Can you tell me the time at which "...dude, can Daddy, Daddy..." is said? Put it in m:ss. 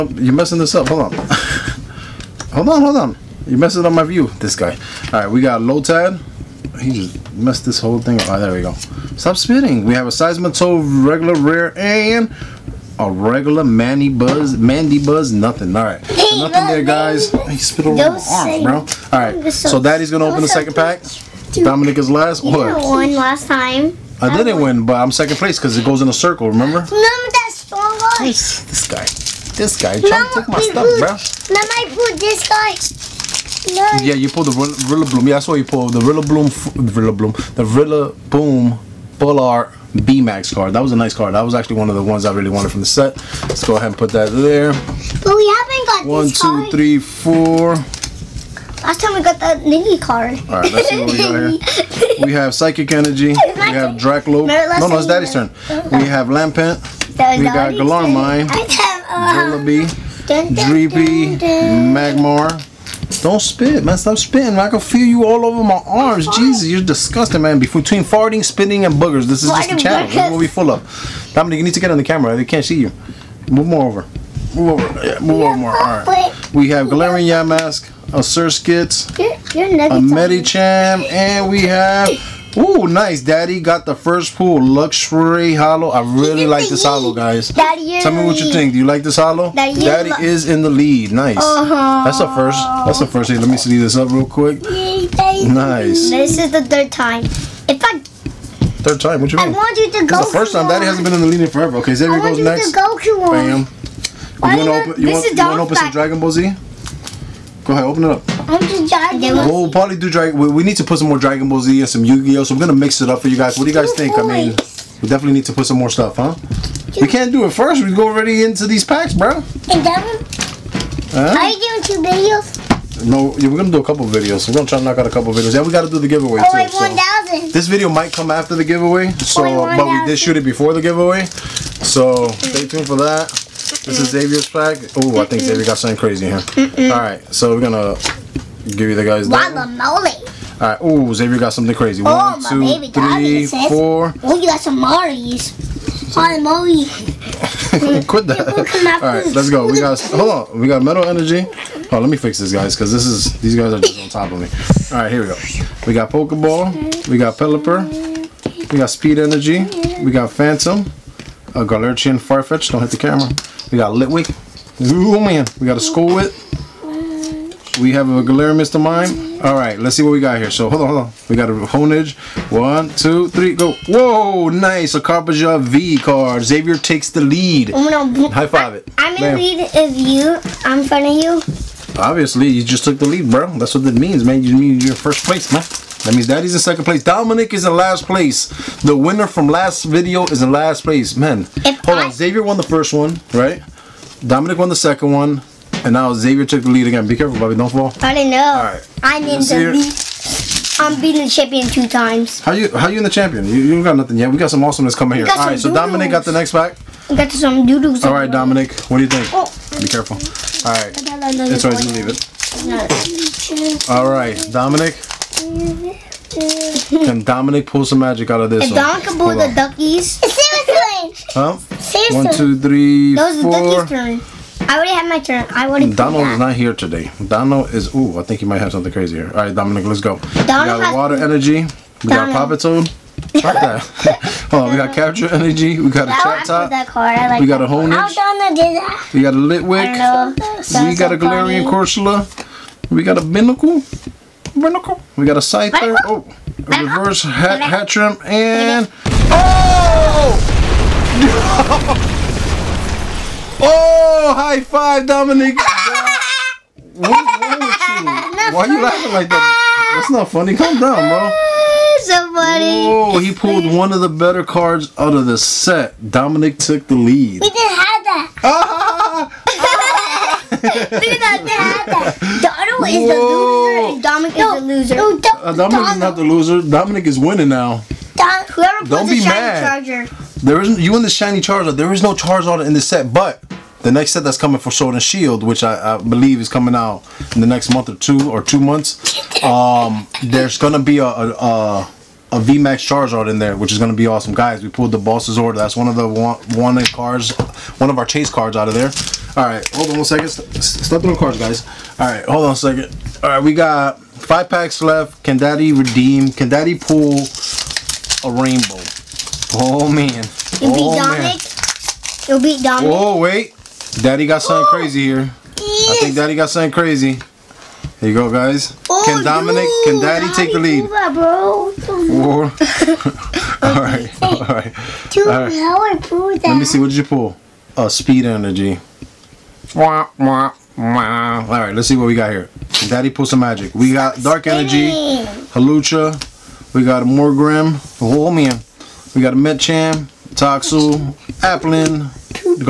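5:19.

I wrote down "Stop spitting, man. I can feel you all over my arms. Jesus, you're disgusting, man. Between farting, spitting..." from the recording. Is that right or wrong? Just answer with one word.
right.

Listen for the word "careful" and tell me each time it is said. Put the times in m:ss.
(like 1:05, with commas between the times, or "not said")
3:17, 3:29.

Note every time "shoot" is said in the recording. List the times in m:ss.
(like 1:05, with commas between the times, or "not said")
2:10.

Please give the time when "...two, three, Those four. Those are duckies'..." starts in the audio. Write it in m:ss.
3:42.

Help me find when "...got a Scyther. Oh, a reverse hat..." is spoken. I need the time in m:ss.
4:05.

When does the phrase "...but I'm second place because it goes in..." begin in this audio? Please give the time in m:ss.
0:24.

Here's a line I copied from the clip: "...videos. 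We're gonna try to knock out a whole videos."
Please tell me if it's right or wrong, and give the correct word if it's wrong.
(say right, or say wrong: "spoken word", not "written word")
wrong: "couple", not "whole".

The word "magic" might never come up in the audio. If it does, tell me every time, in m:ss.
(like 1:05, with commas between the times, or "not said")
3:37, 5:33.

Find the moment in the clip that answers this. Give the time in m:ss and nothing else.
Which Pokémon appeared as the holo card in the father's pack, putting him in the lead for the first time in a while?
1:24.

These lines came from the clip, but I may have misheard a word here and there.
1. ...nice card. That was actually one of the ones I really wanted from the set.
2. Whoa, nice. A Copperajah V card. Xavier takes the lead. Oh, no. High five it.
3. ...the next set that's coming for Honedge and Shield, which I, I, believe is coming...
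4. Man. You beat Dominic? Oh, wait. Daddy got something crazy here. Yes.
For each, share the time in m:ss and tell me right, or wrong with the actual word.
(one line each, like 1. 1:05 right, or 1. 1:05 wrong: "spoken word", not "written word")
1. 0:40 right
2. 2:53 right
3. 4:43 wrong: "Sword", not "Honedge"
4. 5:11 right.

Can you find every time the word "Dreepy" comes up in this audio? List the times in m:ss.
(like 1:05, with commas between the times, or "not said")
1:00.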